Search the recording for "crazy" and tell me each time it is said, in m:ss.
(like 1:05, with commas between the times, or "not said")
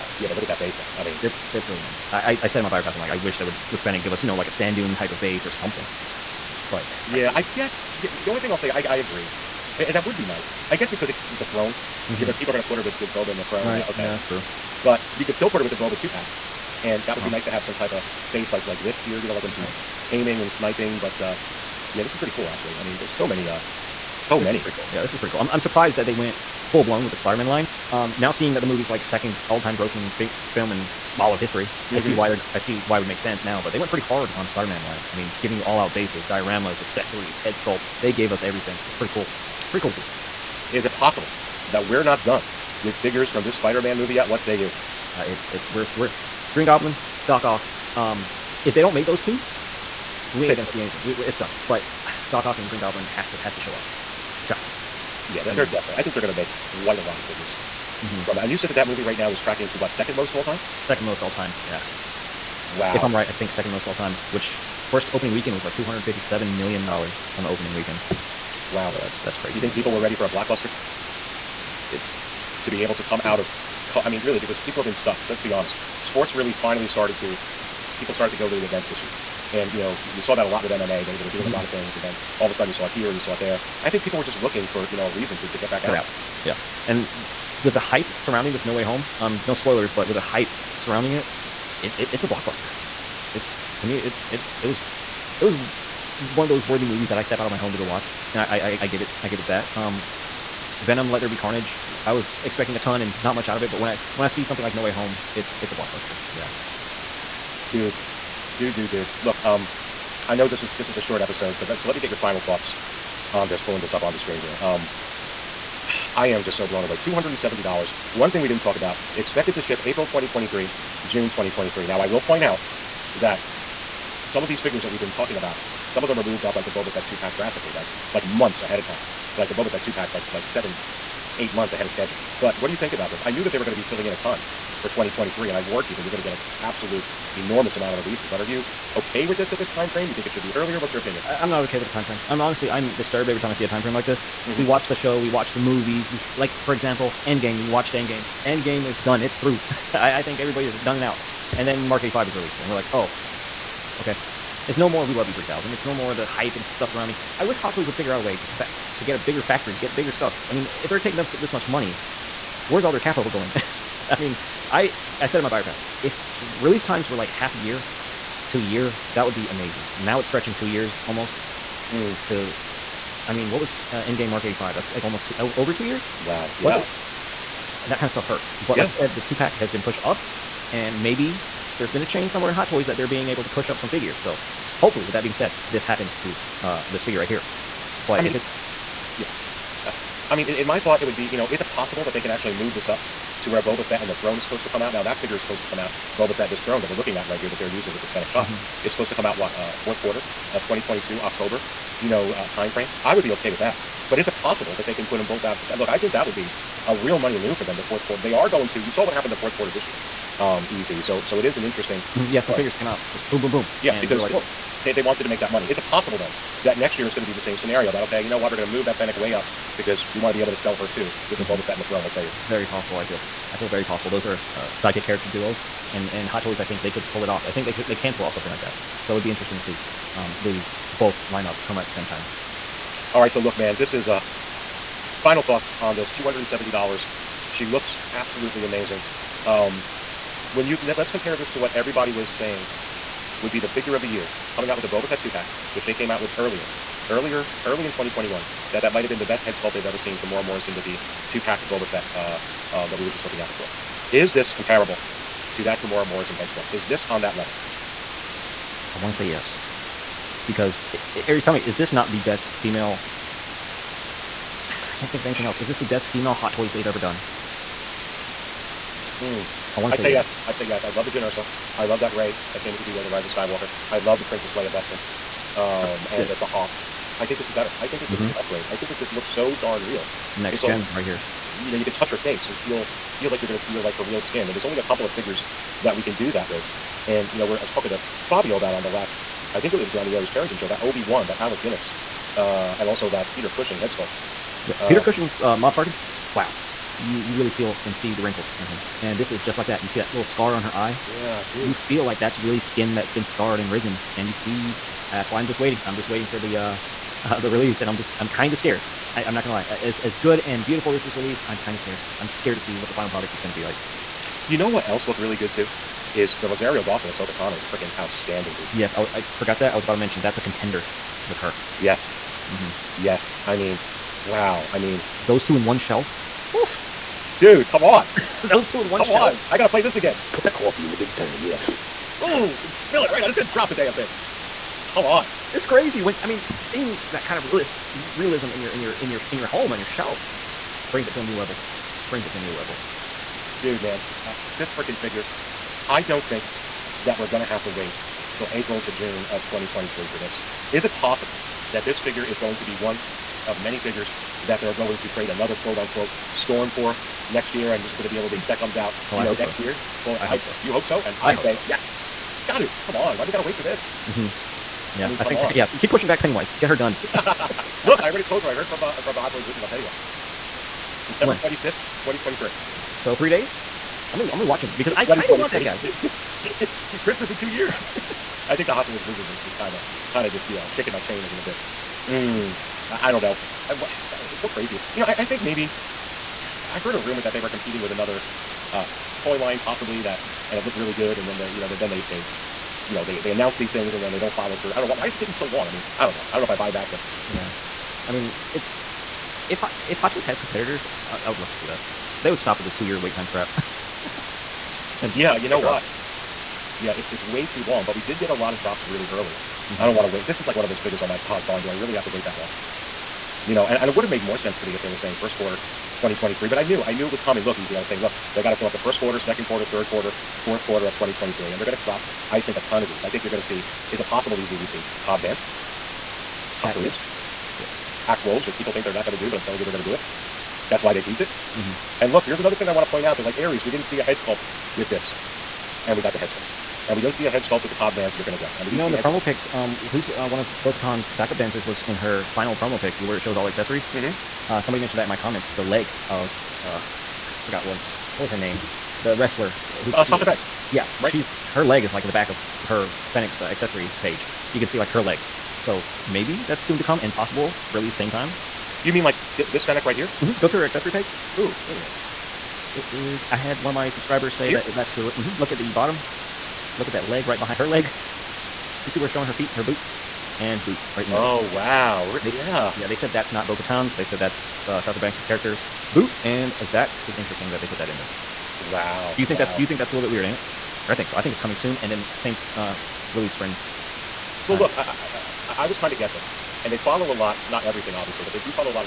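1:09, 5:35, 6:24.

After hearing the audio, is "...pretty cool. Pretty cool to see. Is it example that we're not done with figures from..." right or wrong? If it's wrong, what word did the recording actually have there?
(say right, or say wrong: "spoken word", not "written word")
wrong: "possible", not "example".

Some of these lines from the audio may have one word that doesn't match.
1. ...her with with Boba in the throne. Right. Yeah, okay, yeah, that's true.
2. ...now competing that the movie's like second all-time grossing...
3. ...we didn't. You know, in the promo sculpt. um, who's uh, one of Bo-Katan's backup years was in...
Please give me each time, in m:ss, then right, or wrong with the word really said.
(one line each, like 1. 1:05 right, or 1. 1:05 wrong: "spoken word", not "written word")
1. 0:12 right
2. 0:28 wrong: "seeing", not "competing"
3. 7:18 wrong: "dancers", not "years".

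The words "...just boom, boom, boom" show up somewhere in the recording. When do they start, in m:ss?
3:33.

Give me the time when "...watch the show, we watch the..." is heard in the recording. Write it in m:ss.
2:24.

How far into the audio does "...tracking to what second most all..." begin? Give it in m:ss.
0:59.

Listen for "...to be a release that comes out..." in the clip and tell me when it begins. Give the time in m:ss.
5:58.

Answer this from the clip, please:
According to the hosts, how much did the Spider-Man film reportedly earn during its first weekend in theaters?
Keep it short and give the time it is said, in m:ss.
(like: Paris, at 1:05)
$257 million, at 1:05.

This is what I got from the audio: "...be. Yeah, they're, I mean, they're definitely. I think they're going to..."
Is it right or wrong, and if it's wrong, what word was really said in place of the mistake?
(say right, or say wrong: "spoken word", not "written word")
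right.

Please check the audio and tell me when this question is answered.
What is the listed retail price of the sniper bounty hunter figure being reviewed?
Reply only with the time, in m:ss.
1:56.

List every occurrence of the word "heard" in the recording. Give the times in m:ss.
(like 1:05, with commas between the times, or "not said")
6:08, 6:26.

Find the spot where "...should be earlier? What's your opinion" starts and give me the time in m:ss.
2:20.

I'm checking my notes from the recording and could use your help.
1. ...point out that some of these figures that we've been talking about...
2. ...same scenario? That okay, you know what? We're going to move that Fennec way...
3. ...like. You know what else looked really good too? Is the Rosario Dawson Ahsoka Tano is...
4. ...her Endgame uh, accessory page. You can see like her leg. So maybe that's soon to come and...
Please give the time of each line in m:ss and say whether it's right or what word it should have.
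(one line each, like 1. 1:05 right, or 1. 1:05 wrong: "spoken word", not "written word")
1. 2:02 right
2. 3:37 right
3. 5:13 right
4. 7:32 wrong: "Fennec", not "Endgame".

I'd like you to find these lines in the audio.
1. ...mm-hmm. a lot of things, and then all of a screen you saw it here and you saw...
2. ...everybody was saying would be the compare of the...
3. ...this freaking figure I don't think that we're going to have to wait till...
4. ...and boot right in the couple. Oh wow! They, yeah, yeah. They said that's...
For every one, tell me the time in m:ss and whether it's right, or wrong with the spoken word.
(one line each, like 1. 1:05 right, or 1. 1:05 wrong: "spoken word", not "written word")
1. 1:21 wrong: "sudden", not "screen"
2. 4:01 wrong: "figure", not "compare"
3. 5:44 right
4. 7:50 wrong: "middle", not "couple".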